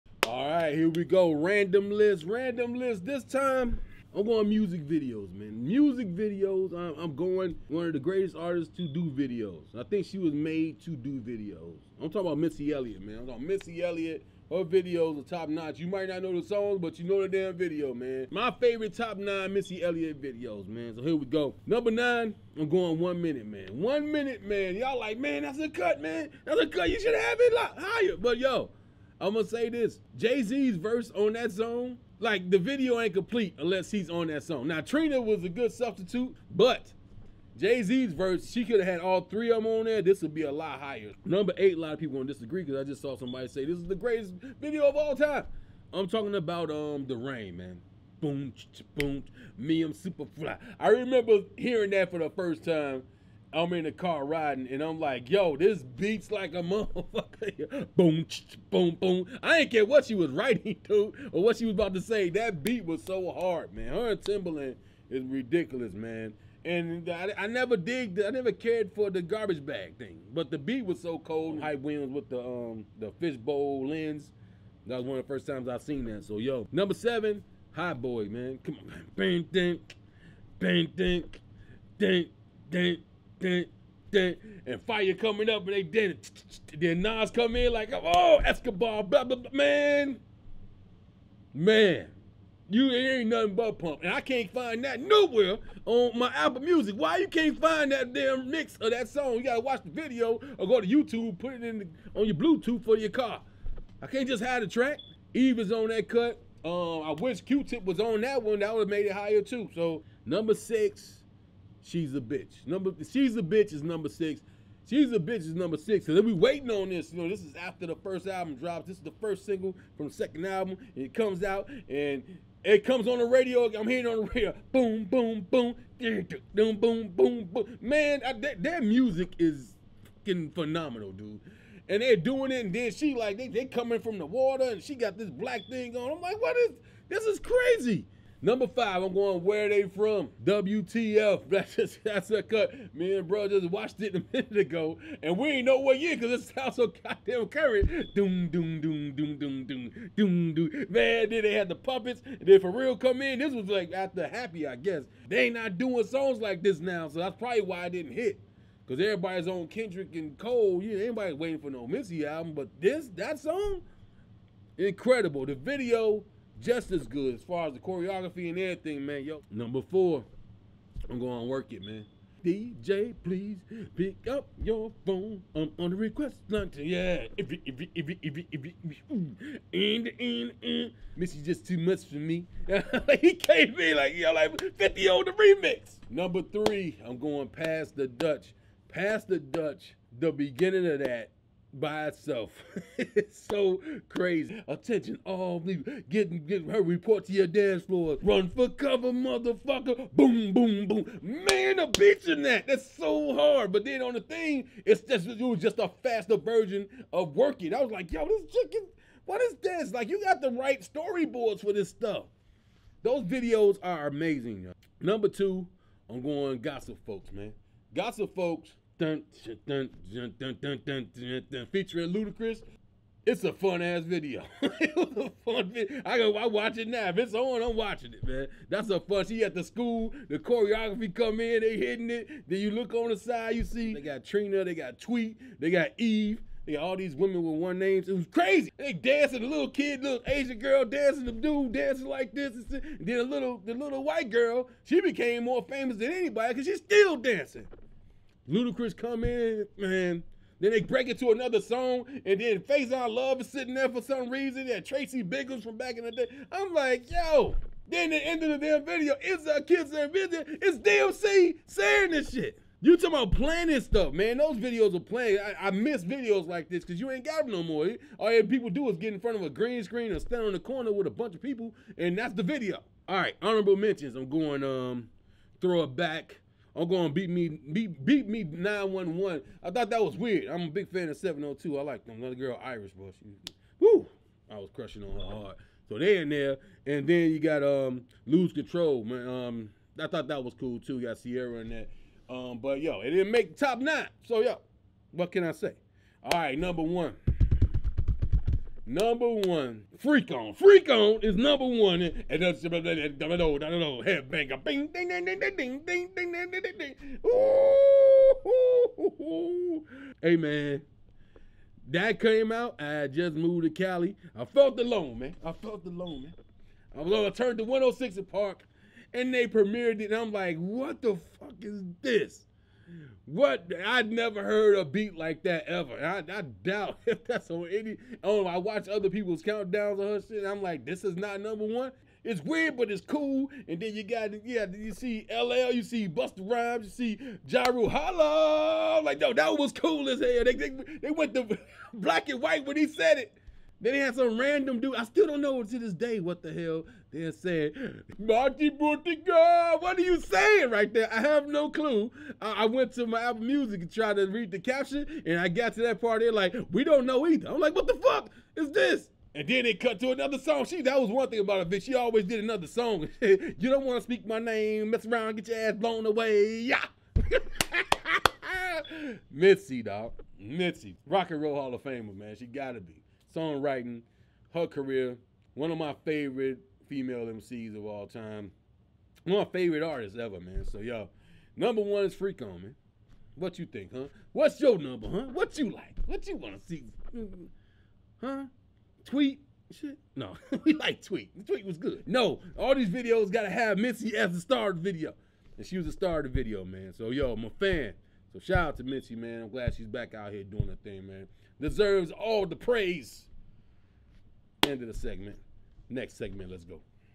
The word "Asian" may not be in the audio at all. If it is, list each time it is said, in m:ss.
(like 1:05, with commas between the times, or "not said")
4:00.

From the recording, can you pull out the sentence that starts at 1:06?
And I, I never digged, I never cared for the garbage bag thing, but the beat was so cold.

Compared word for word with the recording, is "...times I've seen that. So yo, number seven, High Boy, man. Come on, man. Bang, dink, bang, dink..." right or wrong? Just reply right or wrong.
right.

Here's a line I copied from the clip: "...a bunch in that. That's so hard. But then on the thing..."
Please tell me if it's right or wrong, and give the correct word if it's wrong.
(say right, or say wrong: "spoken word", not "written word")
wrong: "bitch", not "bunch".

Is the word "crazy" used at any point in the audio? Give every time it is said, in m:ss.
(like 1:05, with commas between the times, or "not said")
2:17, 3:14, 3:58.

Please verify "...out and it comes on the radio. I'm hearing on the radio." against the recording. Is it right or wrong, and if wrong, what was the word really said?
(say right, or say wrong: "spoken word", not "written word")
right.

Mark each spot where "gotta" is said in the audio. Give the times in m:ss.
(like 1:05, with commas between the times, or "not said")
1:39, 6:12.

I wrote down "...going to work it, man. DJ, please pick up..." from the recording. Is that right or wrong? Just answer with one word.
right.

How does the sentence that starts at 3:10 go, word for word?
The beginning of that by itself.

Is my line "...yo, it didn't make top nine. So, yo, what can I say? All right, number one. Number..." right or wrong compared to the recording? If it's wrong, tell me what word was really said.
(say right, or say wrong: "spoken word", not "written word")
right.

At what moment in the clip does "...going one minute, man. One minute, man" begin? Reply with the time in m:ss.
0:22.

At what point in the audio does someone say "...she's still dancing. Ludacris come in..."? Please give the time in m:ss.
4:06.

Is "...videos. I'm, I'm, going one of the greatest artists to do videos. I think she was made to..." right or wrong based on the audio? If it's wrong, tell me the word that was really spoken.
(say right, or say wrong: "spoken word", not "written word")
right.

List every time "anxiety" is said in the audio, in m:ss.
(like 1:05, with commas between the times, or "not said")
not said.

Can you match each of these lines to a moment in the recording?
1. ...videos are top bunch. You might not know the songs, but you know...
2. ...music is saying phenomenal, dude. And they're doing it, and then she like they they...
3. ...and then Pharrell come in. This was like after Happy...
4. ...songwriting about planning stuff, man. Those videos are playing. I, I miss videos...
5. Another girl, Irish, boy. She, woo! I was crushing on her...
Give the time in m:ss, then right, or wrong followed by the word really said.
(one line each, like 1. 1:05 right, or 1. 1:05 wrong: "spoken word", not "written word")
1. 0:14 wrong: "notch", not "bunch"
2. 2:08 wrong: "fucking", not "saying"
3. 2:32 right
4. 4:22 wrong: "talking", not "songwriting"
5. 4:42 right.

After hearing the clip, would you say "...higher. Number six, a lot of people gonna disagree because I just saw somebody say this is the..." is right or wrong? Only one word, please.
wrong.